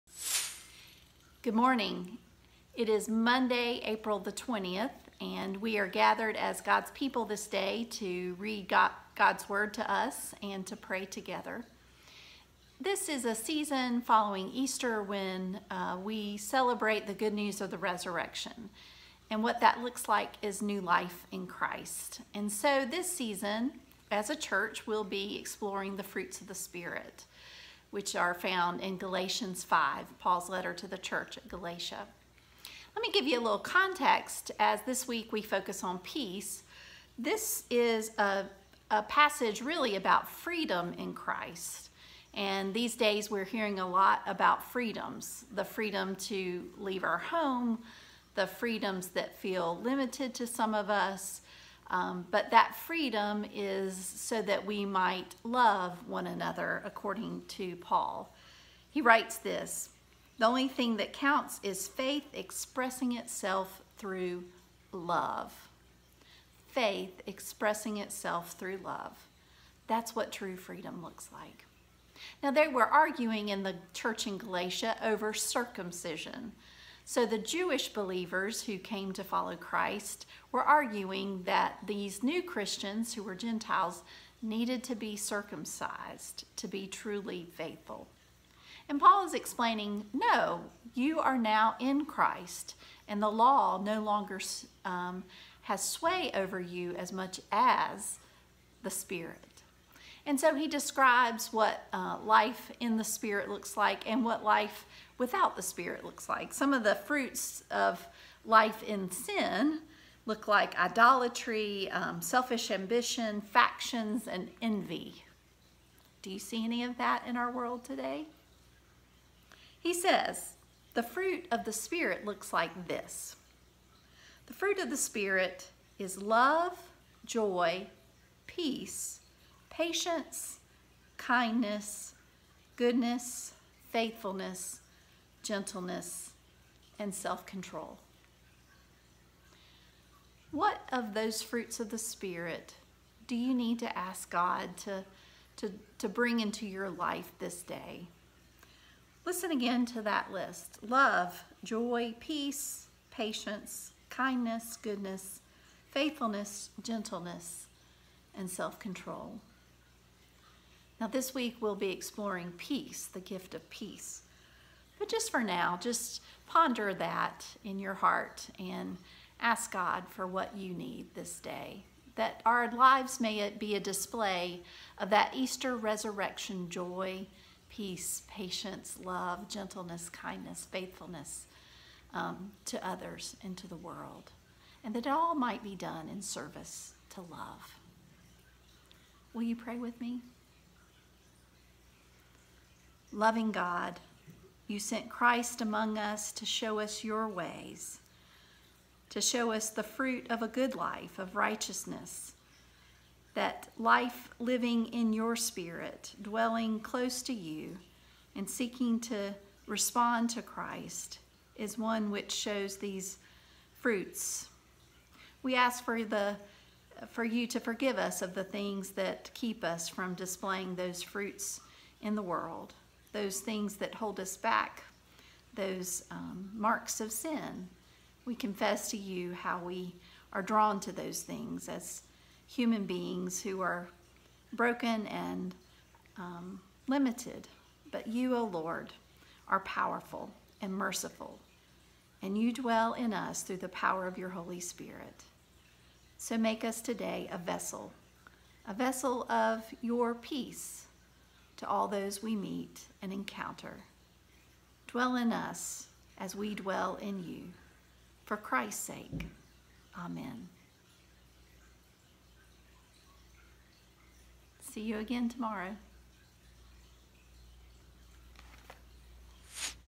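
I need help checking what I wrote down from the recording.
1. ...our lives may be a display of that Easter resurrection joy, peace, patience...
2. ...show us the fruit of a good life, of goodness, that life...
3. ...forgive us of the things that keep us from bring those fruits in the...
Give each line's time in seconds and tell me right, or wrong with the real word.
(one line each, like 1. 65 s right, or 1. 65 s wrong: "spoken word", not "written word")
1. 172 s right
2. 199 s wrong: "righteousness", not "goodness"
3. 217 s wrong: "displaying", not "bring".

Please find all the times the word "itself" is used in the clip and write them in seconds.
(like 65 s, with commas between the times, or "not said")
63 s, 67 s.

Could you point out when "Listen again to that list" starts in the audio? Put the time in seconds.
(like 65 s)
149 s.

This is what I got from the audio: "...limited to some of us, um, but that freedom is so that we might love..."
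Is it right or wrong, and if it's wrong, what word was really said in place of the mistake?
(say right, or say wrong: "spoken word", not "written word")
right.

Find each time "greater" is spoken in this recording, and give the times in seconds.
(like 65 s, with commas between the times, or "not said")
not said.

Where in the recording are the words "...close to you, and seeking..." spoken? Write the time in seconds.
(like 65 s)
206 s.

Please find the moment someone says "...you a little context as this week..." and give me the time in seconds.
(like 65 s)
33 s.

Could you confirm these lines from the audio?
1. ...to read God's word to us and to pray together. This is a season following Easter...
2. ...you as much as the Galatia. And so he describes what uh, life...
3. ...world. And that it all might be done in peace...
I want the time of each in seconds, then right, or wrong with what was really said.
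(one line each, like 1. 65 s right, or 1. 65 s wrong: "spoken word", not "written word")
1. 7 s right
2. 96 s wrong: "Spirit", not "Galatia"
3. 183 s wrong: "service", not "peace".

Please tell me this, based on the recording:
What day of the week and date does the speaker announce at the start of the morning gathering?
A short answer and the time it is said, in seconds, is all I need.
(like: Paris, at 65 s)
Monday, April 20, at 3 s.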